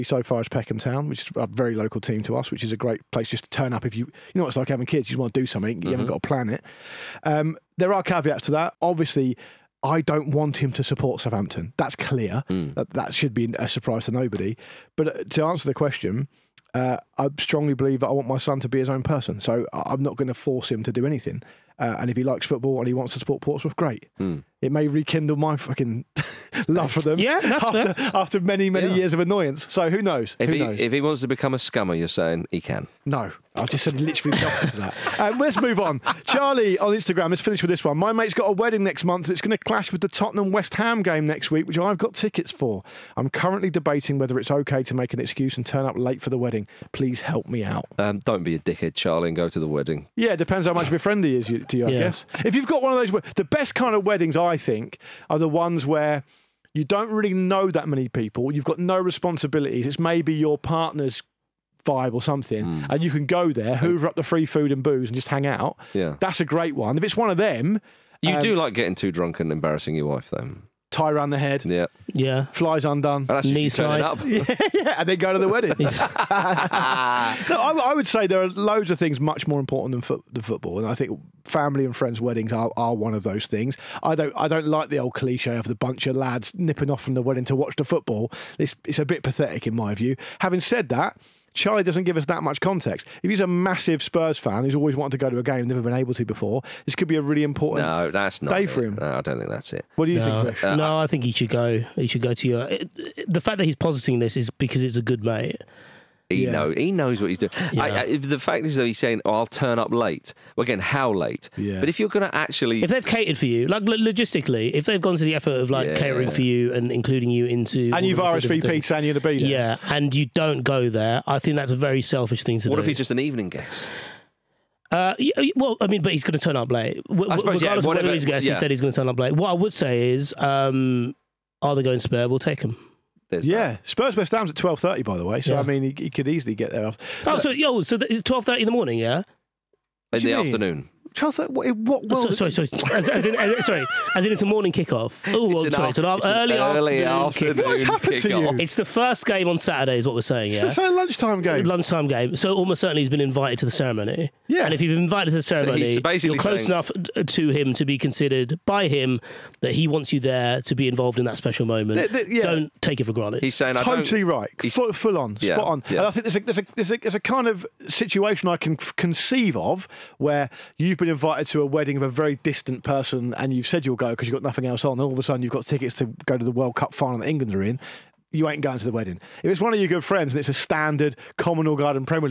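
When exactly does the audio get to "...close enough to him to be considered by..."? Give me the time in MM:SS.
02:36.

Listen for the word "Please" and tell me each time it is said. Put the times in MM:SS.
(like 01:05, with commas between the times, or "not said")
00:46.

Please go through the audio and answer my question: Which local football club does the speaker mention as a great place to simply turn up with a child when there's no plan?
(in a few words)
Peckham Town.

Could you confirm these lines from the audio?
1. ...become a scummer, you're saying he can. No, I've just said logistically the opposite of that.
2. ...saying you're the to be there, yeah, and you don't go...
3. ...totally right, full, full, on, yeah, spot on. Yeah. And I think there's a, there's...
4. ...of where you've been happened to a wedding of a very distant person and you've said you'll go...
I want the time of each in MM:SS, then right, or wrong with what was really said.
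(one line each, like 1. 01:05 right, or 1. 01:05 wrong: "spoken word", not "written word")
1. 00:31 wrong: "literally", not "logistically"
2. 01:58 right
3. 02:43 right
4. 02:49 wrong: "invited", not "happened".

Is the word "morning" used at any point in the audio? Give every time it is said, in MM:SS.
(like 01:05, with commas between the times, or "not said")
02:18, 02:24.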